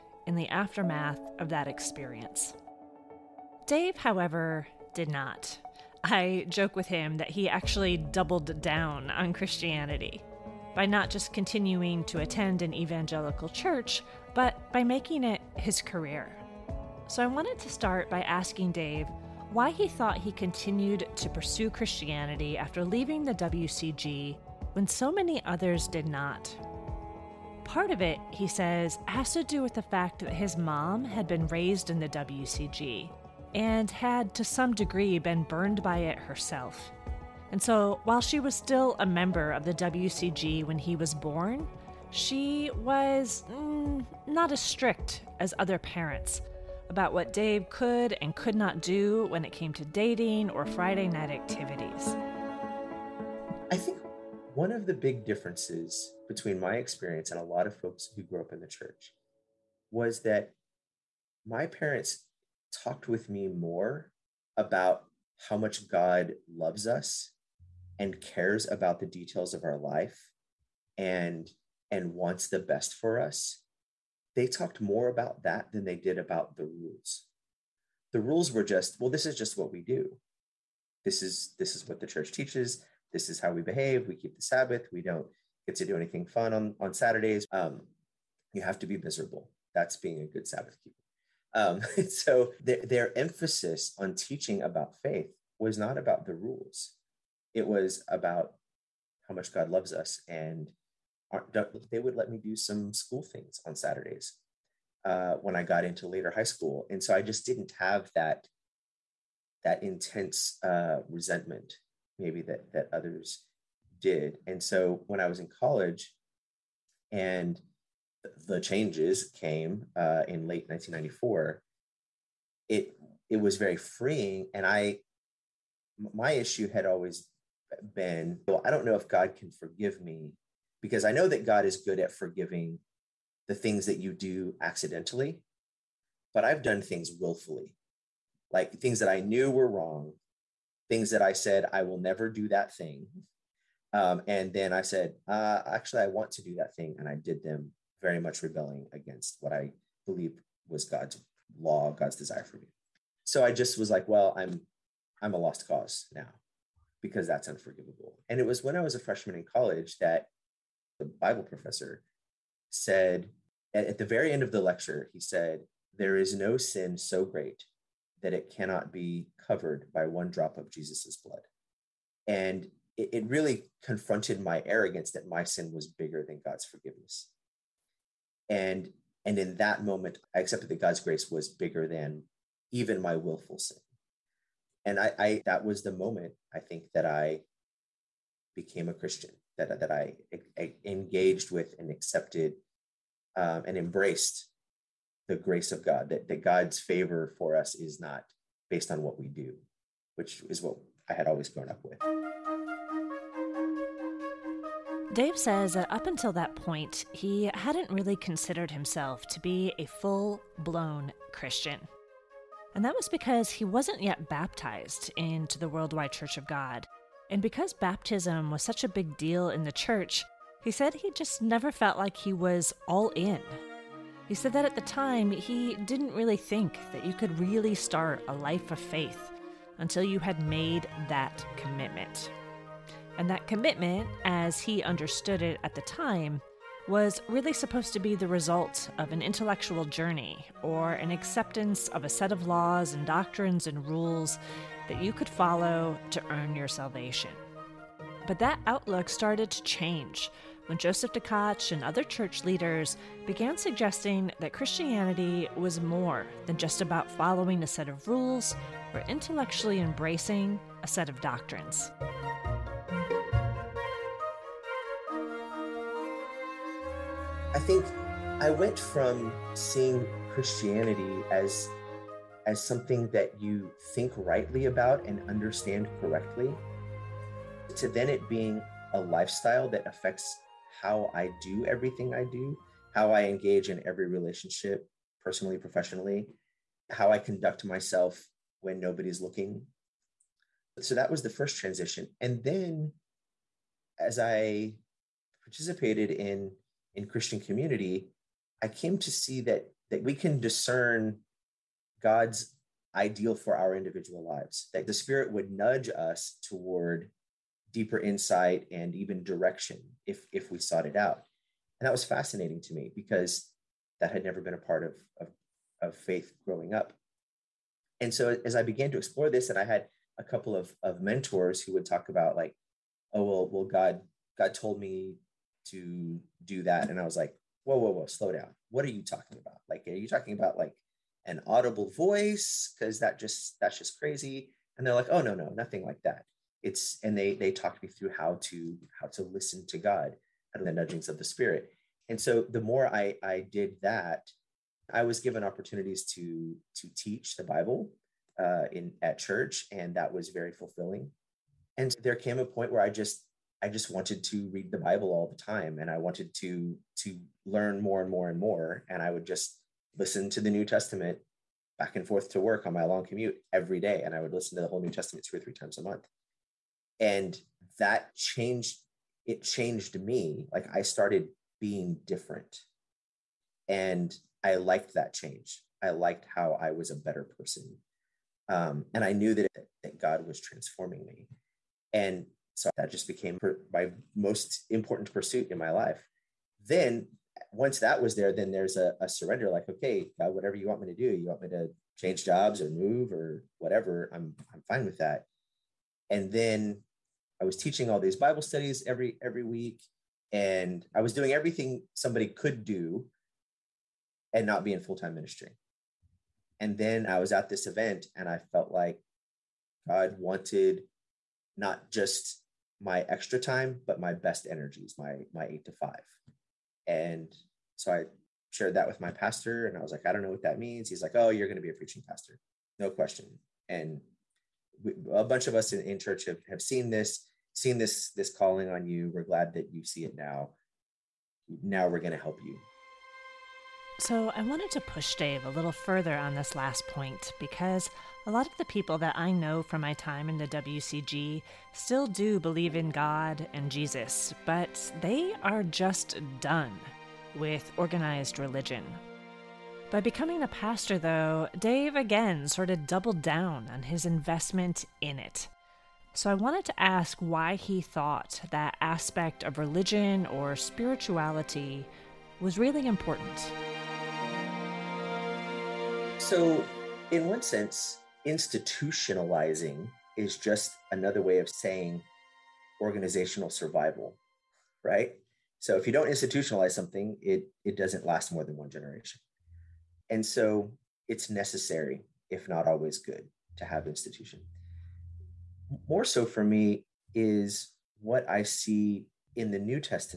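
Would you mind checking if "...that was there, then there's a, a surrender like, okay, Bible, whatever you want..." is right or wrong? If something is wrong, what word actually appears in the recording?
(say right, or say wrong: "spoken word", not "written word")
wrong: "God", not "Bible".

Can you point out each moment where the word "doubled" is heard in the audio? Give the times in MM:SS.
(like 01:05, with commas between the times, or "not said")
00:07, 07:32.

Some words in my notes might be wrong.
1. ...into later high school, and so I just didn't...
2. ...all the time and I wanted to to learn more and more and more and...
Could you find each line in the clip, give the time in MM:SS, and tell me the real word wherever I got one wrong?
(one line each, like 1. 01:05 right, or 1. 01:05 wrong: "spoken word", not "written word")
1. 01:45 right
2. 05:55 right.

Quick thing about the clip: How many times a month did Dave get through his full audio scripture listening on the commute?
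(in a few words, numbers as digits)
2 or 3.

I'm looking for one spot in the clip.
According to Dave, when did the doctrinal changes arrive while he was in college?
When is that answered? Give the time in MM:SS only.
02:00.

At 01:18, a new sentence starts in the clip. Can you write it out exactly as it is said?
The rules were just, well, this is just what we do.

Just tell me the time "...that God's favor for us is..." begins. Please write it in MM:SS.
03:16.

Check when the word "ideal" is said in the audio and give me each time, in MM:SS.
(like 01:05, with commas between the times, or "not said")
05:02.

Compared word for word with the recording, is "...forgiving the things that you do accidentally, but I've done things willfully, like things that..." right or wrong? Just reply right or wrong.
right.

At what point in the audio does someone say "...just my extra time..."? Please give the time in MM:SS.
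06:51.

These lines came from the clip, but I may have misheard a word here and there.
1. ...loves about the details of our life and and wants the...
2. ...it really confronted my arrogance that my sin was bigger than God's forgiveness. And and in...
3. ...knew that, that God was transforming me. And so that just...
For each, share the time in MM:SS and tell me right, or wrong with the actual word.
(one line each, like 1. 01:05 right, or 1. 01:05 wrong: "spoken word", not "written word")
1. 01:08 wrong: "cares", not "loves"
2. 02:53 right
3. 06:19 right.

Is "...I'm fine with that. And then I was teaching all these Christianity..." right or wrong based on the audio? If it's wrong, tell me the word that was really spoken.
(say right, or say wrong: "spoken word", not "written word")
wrong: "Bible", not "Christianity".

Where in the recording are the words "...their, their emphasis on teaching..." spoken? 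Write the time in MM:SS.
01:32.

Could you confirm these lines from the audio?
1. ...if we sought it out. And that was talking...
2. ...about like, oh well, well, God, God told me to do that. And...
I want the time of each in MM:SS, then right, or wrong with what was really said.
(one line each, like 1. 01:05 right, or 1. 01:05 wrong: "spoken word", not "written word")
1. 05:10 wrong: "fascinating", not "talking"
2. 05:22 right.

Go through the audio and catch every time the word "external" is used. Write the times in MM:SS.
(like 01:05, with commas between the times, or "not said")
not said.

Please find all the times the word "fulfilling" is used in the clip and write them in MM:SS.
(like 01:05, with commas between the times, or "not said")
05:50.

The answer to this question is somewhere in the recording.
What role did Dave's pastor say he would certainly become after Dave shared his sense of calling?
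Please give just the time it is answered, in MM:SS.
07:01.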